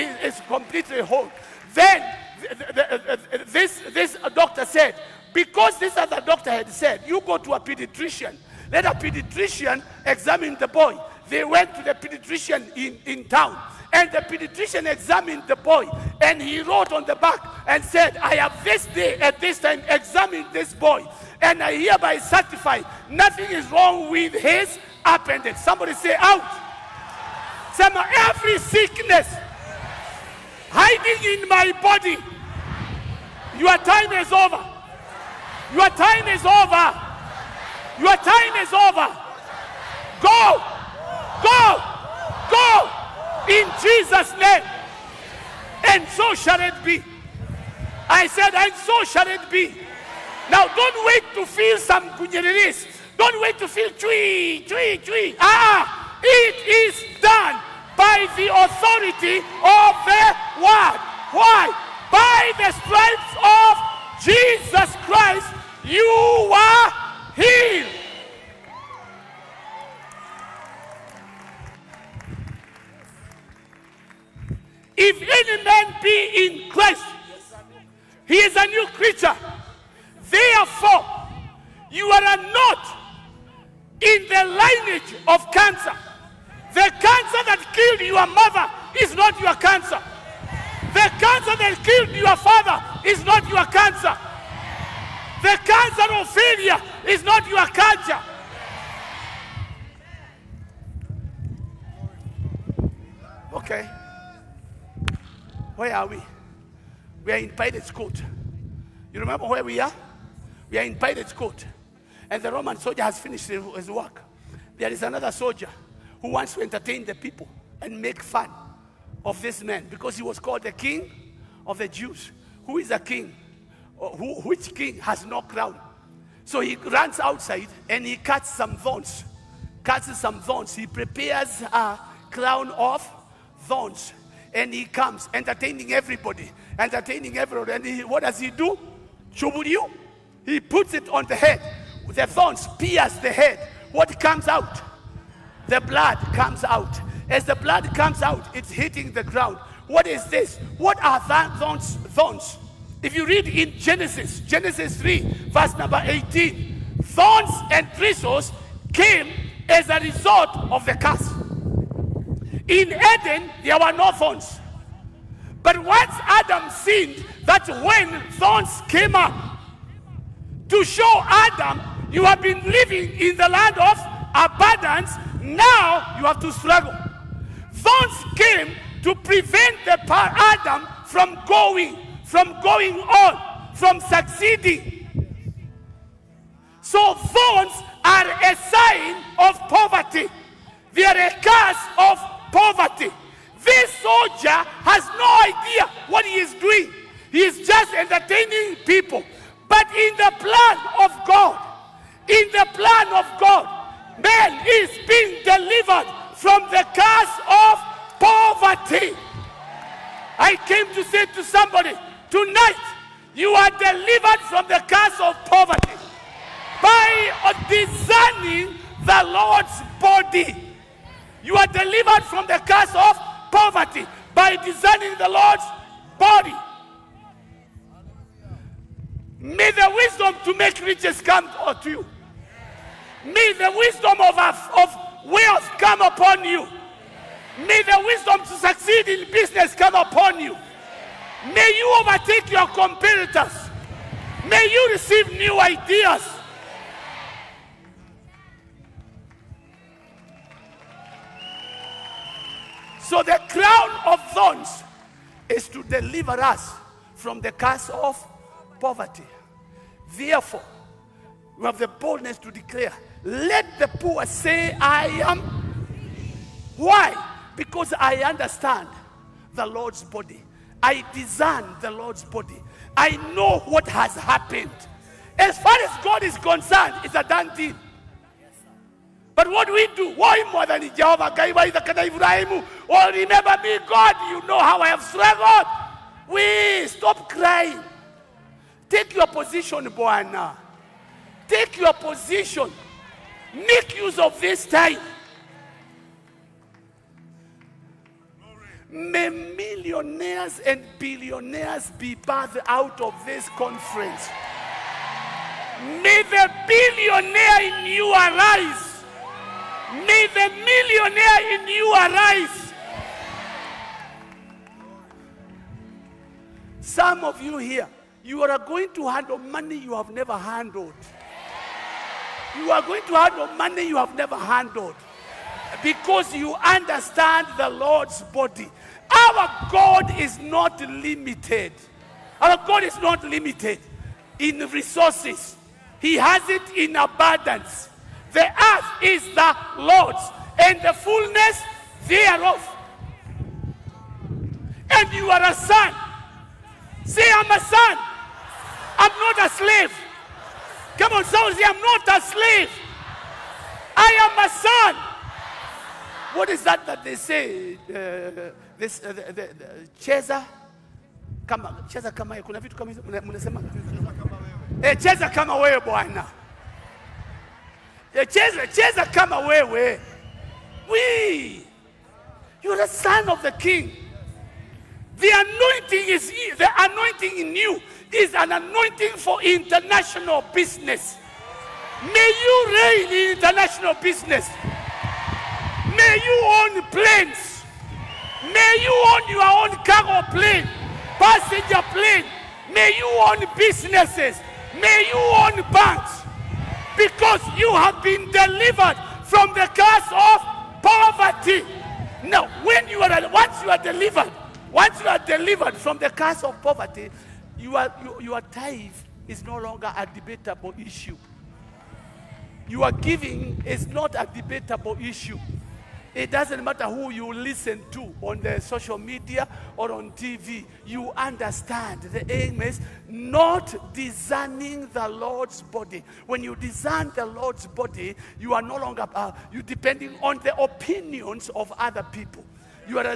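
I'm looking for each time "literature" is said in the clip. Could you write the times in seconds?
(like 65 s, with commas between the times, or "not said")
not said.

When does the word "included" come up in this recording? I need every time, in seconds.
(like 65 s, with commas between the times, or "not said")
not said.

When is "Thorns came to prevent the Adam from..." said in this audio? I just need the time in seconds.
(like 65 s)
177 s.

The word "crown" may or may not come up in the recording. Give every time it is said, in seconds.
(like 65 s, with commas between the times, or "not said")
125 s, 132 s, 253 s.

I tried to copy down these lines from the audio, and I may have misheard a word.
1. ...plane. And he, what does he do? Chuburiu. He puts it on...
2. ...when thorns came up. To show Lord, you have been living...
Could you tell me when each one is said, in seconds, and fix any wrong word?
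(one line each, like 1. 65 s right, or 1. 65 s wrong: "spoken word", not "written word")
1. 137 s wrong: "everyone", not "plane"
2. 167 s wrong: "Adam", not "Lord".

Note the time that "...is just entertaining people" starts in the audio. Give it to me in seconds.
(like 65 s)
197 s.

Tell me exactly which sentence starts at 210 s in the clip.
I came to say to somebody, tonight you are delivered from the curse of poverty by discerning the Lord's body.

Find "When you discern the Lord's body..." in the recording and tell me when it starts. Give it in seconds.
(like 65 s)
426 s.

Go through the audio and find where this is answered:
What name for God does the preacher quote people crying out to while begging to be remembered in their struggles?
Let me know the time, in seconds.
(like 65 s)
280 s.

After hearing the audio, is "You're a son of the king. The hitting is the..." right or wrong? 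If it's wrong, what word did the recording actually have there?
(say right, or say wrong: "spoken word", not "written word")
wrong: "anointing", not "hitting".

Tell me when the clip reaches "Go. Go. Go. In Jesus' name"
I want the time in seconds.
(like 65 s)
40 s.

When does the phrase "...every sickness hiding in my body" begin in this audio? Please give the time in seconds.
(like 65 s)
27 s.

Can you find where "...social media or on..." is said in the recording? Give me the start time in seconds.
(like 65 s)
418 s.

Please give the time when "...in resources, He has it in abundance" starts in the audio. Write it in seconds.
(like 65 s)
334 s.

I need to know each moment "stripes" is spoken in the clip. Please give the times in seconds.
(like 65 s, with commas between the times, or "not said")
62 s.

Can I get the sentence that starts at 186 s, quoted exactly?
So thorns are a sign of poverty.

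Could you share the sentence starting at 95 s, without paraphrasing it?
The cancer of failure is not your cancer.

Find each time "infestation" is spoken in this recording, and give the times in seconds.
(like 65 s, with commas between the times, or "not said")
not said.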